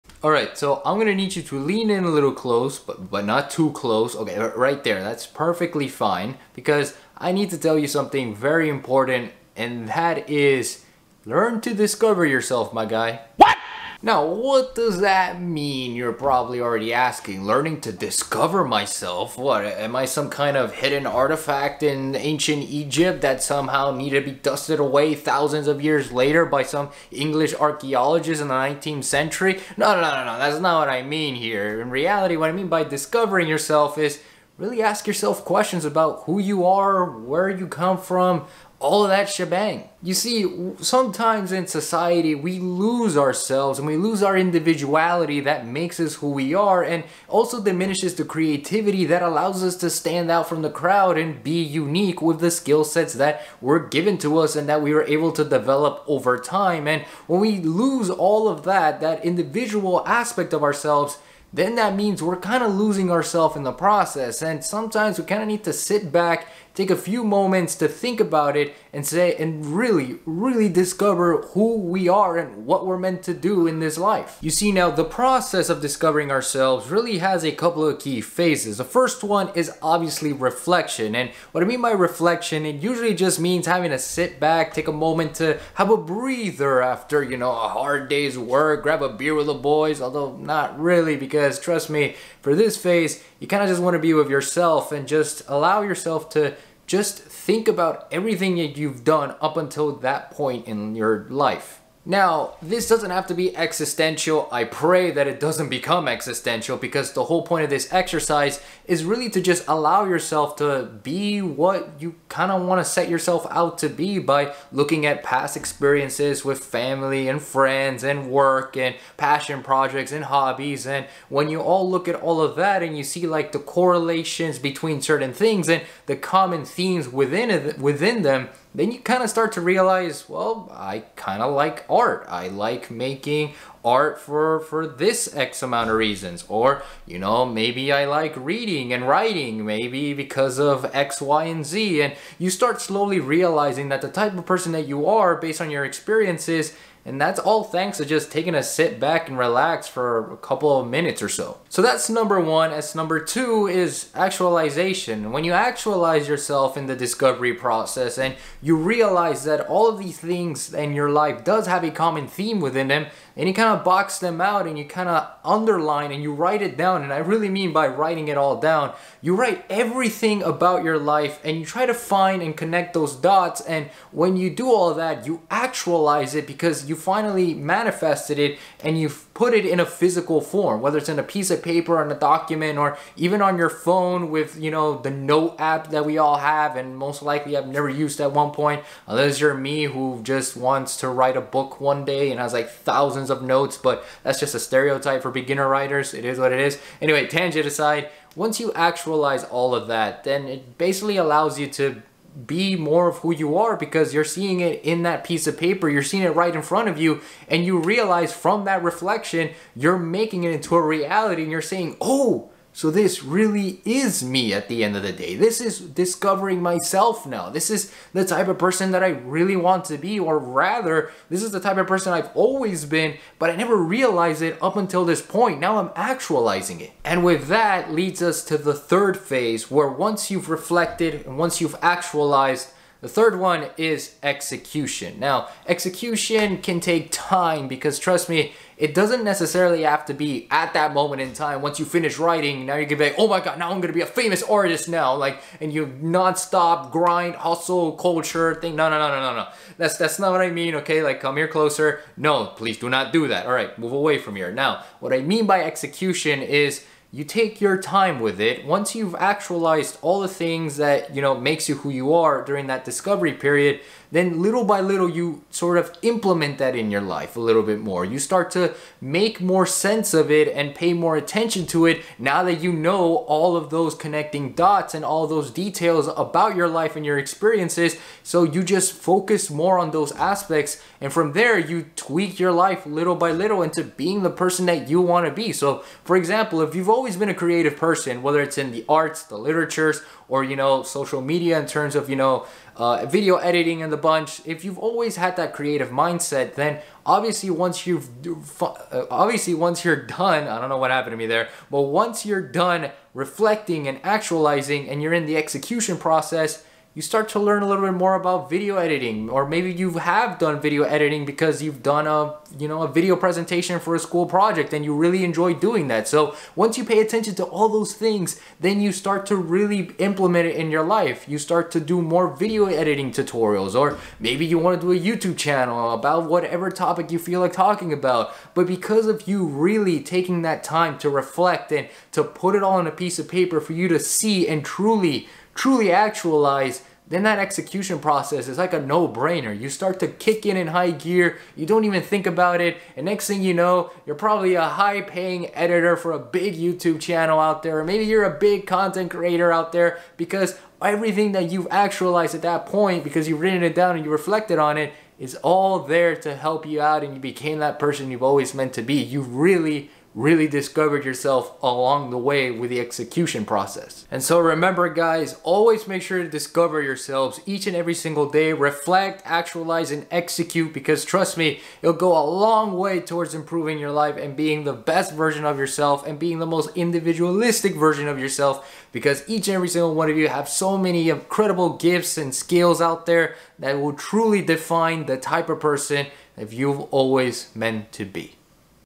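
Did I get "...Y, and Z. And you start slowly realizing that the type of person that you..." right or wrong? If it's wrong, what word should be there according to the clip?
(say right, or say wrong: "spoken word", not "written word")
right.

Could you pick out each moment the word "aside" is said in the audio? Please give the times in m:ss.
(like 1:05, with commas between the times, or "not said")
3:17.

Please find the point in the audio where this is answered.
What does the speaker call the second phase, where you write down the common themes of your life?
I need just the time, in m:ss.
2:34.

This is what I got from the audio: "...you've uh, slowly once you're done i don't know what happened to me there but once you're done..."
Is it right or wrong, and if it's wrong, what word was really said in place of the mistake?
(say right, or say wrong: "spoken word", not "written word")
wrong: "obviously", not "slowly".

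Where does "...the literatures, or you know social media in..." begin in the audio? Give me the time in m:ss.
4:49.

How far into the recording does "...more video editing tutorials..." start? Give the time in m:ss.
5:22.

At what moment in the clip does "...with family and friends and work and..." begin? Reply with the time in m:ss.
1:56.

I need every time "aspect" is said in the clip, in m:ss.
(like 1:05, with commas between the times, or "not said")
1:00, 4:40.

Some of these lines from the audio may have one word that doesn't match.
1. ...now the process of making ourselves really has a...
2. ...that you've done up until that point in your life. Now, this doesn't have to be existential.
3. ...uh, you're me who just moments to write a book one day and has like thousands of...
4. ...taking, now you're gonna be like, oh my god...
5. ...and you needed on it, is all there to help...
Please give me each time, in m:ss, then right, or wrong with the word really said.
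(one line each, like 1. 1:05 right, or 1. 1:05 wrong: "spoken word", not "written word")
1. 1:14 wrong: "discovering", not "making"
2. 1:38 right
3. 3:09 wrong: "wants", not "moments"
4. 4:02 wrong: "writing", not "taking"
5. 5:53 wrong: "reflected", not "needed".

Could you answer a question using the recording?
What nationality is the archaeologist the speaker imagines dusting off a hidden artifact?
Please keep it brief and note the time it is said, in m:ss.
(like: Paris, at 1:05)
English, at 0:27.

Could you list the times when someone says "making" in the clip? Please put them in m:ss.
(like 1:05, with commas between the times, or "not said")
2:12, 3:29.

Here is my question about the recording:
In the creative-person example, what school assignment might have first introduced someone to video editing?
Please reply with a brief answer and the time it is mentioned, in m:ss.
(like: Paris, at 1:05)
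Video presentation, at 5:12.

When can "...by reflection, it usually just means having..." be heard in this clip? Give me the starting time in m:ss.
1:21.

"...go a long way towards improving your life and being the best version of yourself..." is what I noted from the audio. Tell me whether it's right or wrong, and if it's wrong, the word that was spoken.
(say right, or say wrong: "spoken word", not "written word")
right.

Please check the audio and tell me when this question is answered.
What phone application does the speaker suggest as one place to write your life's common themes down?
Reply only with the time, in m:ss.
3:05.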